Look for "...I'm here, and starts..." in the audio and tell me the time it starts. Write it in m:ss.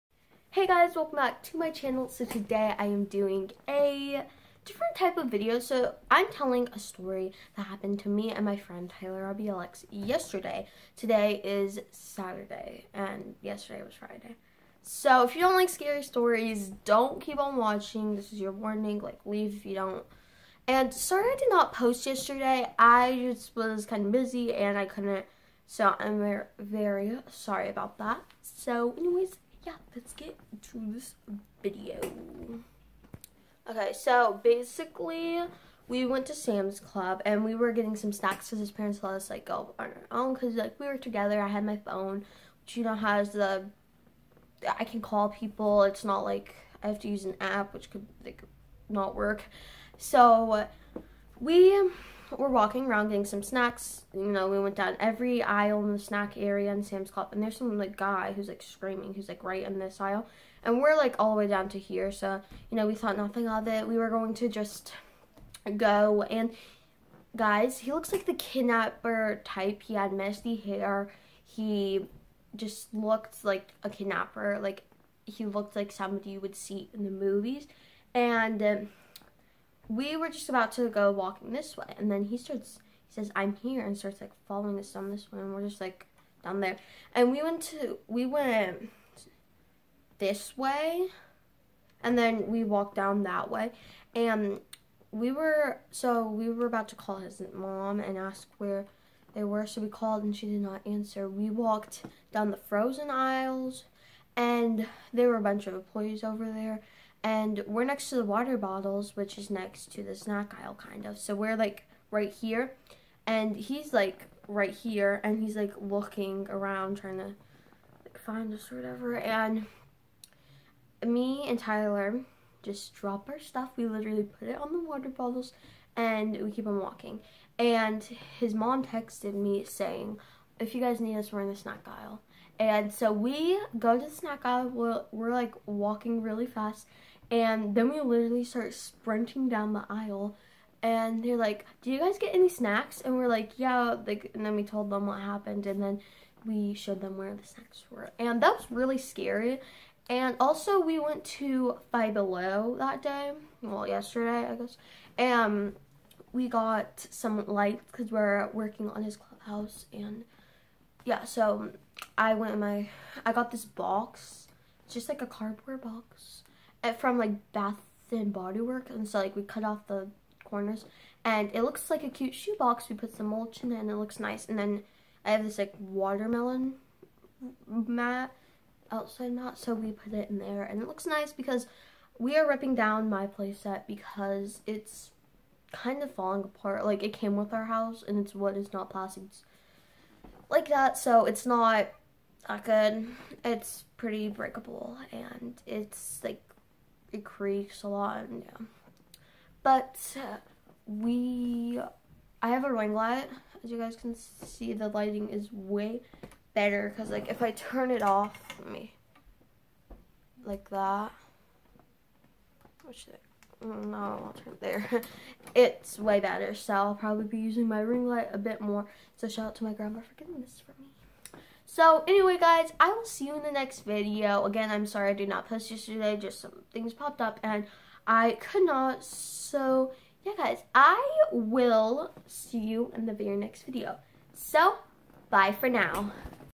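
1:23.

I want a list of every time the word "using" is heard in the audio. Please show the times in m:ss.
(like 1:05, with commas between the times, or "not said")
3:37.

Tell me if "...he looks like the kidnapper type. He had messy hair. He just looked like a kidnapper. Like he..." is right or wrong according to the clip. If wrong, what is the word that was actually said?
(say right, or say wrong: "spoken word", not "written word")
right.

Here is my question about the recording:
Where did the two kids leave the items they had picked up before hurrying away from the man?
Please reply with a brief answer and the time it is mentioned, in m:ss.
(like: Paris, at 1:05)
On the water bottles, at 2:04.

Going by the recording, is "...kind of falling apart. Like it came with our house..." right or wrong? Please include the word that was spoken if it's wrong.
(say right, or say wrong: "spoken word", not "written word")
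right.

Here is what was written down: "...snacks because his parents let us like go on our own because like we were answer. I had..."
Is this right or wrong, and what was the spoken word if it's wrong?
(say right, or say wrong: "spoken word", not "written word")
wrong: "together", not "answer".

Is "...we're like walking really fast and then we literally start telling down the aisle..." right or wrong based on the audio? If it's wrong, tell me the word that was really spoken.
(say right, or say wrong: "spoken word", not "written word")
wrong: "sprinting", not "telling".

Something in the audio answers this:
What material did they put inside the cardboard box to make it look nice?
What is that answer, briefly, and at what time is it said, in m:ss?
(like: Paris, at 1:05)
Mulch, at 2:53.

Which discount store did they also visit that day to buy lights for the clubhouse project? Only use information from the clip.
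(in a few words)
Five Below.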